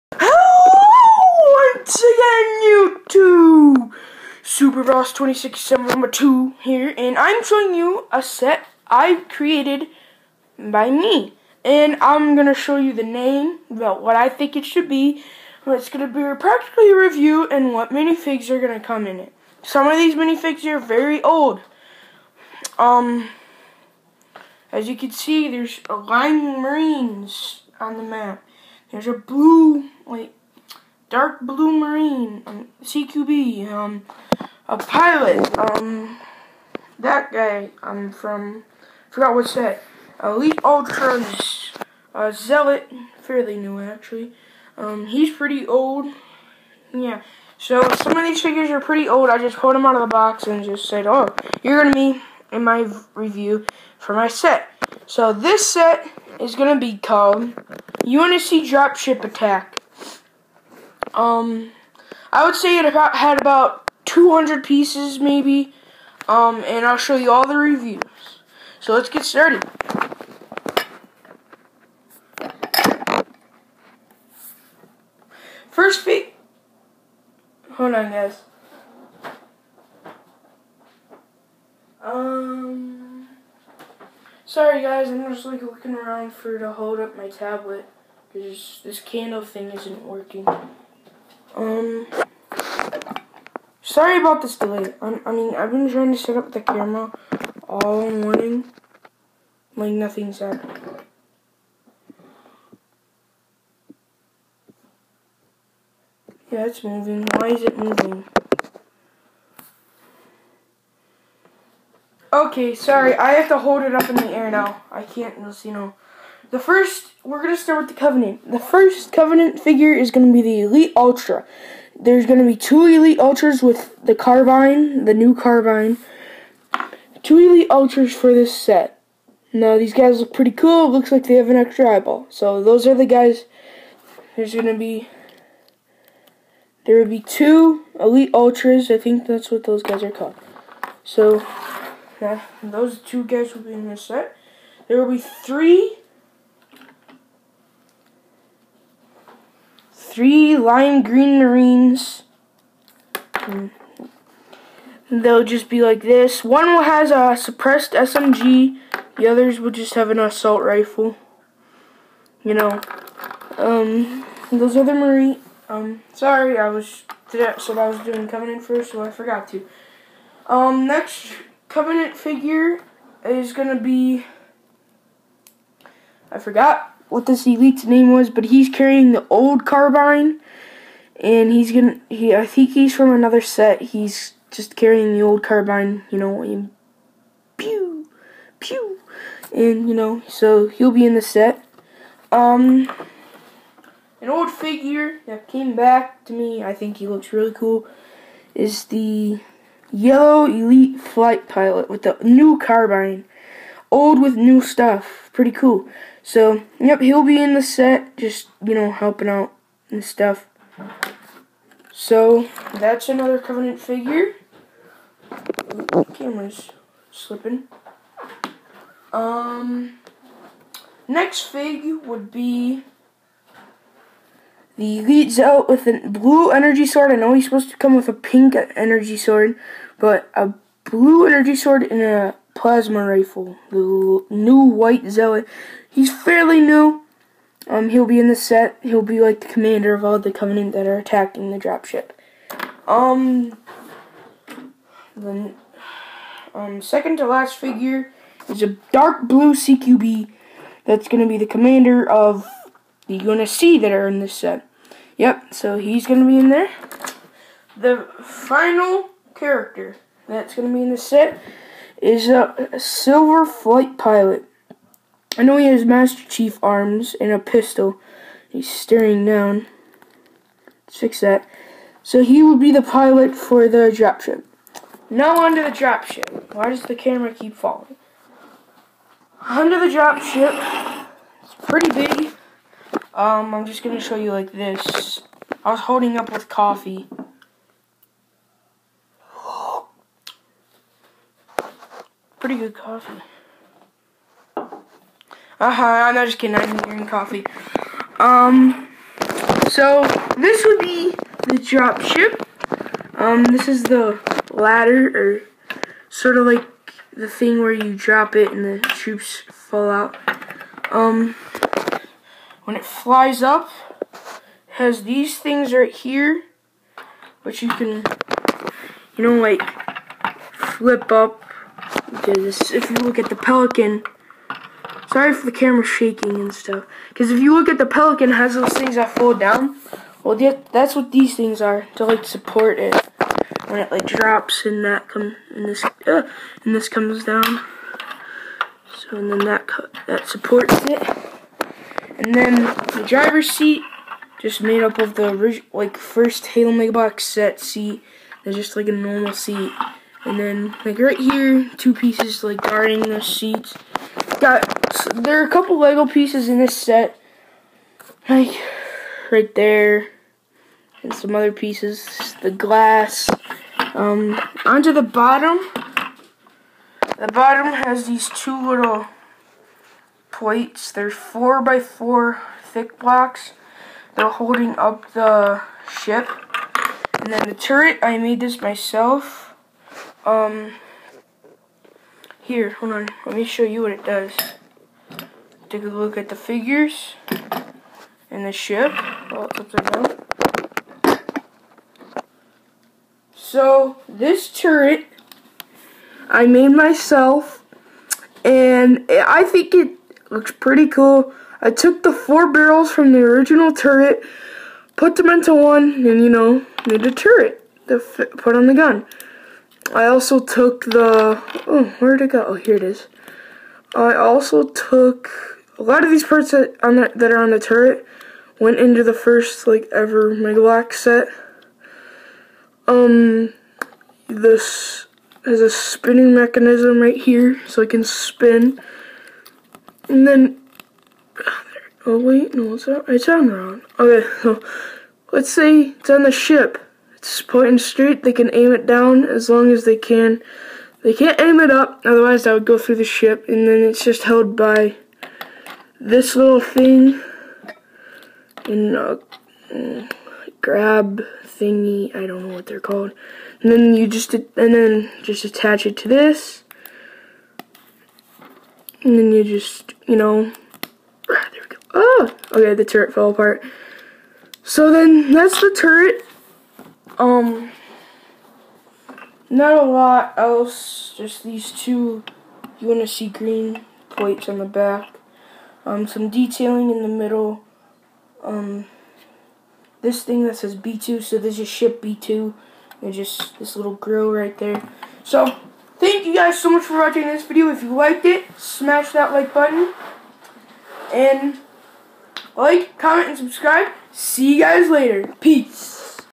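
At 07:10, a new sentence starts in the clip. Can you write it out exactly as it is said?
And then, oh wait, no, it's, on, it's on wrong.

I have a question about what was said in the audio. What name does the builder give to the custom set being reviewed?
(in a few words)
UNSC Dropship Attack.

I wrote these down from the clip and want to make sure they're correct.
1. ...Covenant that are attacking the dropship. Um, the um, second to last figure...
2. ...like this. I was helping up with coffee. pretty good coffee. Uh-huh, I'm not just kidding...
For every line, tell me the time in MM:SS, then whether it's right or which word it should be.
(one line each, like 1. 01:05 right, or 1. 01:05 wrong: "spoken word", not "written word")
1. 04:00 right
2. 04:44 wrong: "holding", not "helping".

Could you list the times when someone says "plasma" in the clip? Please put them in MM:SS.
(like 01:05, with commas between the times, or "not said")
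03:52.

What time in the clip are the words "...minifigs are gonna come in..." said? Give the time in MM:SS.
00:17.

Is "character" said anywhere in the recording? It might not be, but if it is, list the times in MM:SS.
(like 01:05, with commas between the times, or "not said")
04:19.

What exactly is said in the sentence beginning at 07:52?
You want to see green plates on the back.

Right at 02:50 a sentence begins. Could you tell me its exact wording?
Um, next Covenant figure is gonna be.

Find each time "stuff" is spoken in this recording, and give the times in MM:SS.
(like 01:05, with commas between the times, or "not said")
03:24, 03:30, 05:26.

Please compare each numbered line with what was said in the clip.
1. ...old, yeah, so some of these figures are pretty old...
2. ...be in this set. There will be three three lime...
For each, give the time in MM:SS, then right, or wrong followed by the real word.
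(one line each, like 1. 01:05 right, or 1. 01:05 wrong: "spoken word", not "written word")
1. 00:45 right
2. 02:23 right.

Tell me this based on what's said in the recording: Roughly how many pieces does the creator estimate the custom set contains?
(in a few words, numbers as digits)
200.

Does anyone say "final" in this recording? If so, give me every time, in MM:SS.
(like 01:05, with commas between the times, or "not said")
04:18.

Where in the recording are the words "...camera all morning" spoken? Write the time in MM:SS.
01:36.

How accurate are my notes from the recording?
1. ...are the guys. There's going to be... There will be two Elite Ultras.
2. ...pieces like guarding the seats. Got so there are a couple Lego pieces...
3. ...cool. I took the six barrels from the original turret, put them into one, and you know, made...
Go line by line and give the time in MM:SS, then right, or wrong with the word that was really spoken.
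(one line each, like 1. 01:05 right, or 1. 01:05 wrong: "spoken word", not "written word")
1. 02:12 right
2. 05:51 right
3. 06:40 wrong: "four", not "six".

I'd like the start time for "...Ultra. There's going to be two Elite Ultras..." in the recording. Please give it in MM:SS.
02:00.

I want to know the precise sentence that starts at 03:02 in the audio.
He I think he's from another set.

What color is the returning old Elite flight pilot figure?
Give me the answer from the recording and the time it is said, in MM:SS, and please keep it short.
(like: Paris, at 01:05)
yellow, at 03:19.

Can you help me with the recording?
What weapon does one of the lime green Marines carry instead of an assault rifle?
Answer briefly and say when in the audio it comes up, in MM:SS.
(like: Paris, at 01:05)
suppressed SMG, at 02:37.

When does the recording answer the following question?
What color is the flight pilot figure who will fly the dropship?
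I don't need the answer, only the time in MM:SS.
04:22.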